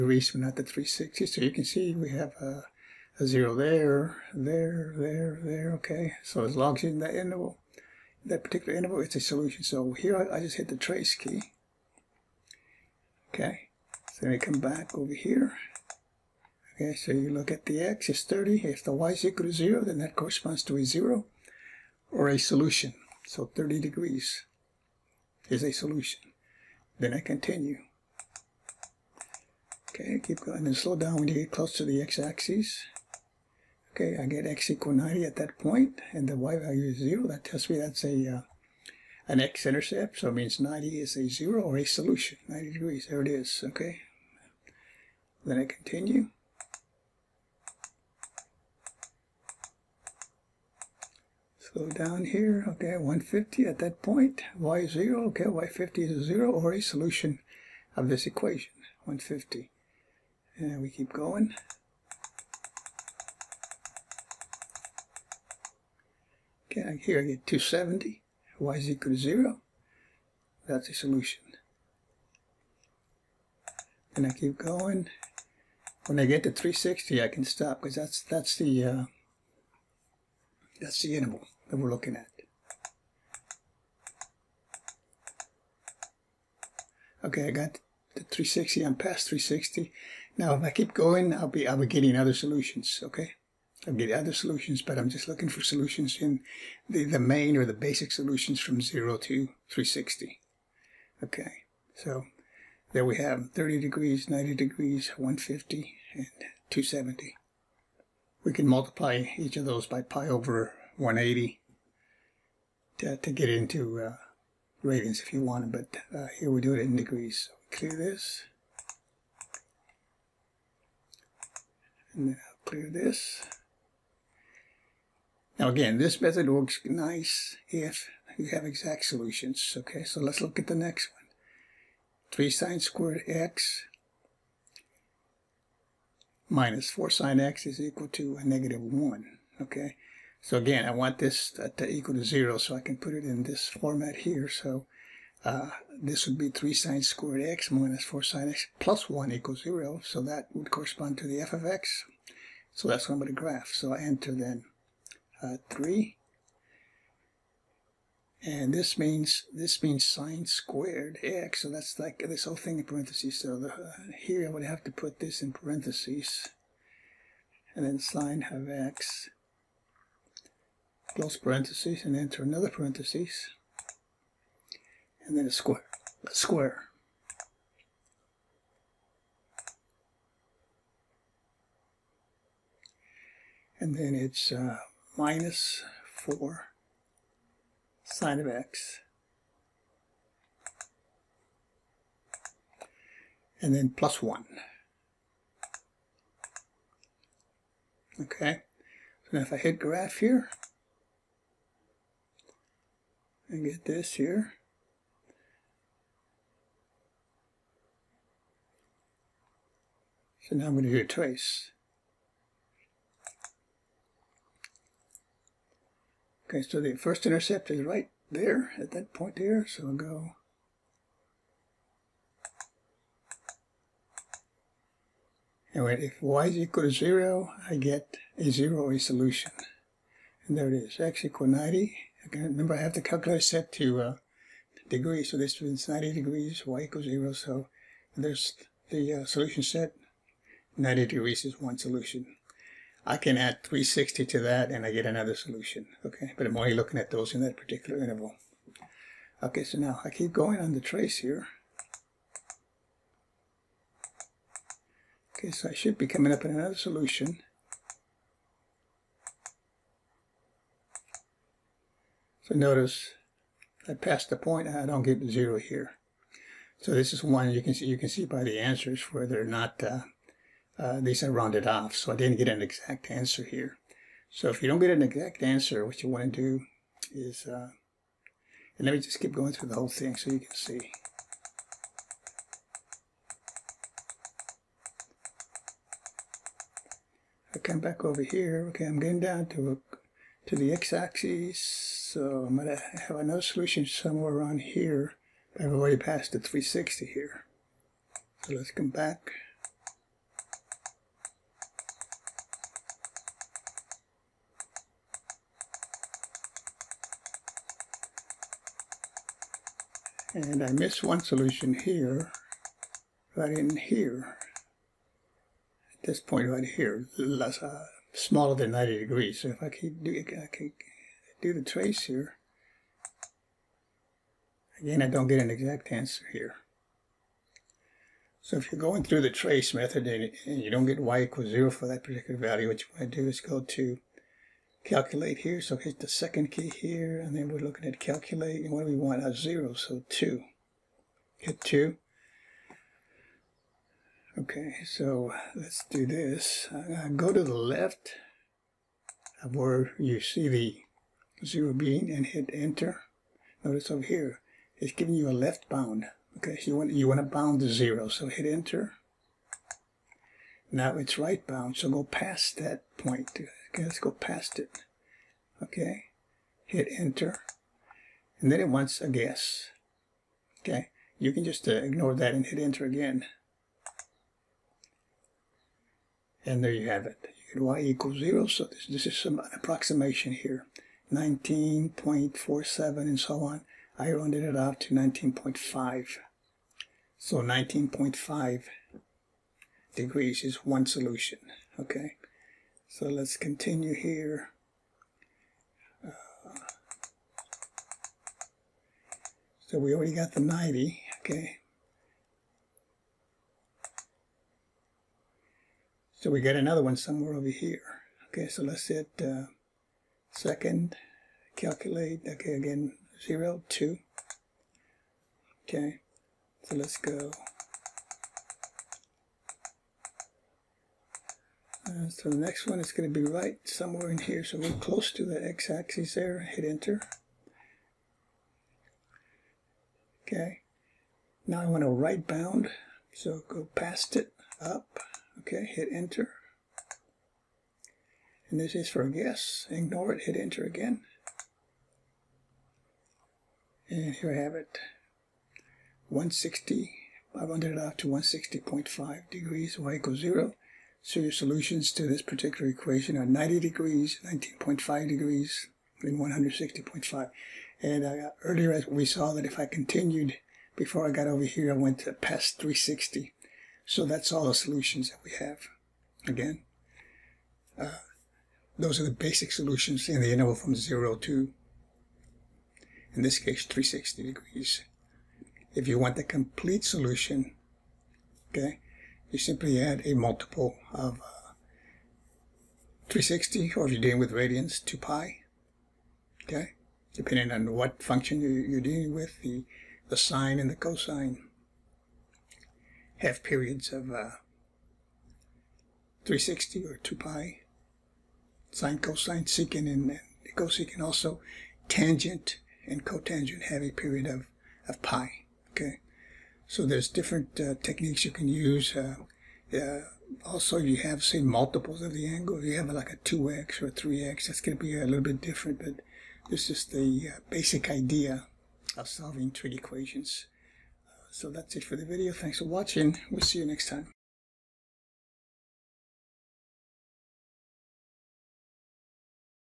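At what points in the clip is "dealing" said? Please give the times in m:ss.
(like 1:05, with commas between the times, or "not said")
8:04, 8:08.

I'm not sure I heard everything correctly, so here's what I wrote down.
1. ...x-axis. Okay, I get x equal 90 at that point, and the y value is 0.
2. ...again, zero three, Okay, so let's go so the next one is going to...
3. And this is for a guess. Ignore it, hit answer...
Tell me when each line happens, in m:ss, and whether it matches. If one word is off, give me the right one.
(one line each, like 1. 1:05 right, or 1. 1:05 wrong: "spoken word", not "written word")
1. 0:32 right
2. 6:52 wrong: "two", not "three"
3. 7:18 wrong: "enter", not "answer".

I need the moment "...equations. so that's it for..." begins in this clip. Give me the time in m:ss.
8:39.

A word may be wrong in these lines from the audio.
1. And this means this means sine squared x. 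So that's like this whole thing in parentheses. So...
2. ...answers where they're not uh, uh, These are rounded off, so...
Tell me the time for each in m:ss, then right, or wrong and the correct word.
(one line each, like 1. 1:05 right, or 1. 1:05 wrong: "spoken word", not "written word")
1. 2:38 right
2. 4:28 right.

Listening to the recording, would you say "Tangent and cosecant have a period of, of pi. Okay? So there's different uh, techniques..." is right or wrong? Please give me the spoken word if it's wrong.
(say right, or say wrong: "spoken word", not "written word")
wrong: "cotangent", not "cosecant".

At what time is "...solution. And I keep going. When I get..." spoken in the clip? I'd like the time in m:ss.
1:10.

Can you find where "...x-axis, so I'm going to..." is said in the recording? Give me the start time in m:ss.
4:50.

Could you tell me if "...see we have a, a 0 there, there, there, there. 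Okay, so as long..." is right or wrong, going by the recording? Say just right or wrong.
right.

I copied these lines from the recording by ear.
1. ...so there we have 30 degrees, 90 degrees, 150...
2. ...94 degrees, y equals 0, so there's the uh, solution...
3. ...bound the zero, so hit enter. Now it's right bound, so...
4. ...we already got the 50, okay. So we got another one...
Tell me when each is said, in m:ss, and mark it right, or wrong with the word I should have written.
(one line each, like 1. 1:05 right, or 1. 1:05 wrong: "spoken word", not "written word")
1. 1:41 right
2. 3:55 wrong: "90", not "94"
3. 5:57 right
4. 6:39 wrong: "90", not "50".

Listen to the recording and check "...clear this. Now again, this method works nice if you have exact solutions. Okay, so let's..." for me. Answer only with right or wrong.
right.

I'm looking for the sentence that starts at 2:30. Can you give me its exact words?
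So that would correspond to the f of x.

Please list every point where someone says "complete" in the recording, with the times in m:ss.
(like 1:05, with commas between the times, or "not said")
7:56.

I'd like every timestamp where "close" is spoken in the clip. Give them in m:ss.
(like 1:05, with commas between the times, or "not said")
0:31, 2:51, 7:04.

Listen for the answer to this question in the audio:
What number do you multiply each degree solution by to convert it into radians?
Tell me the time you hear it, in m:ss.
1:50.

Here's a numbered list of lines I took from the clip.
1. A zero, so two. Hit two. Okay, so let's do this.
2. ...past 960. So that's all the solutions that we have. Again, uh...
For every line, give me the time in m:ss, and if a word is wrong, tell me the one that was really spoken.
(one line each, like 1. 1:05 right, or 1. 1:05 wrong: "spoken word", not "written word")
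1. 5:39 right
2. 7:42 wrong: "360", not "960".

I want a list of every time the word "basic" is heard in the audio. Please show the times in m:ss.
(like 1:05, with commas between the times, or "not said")
1:37, 7:49, 8:37.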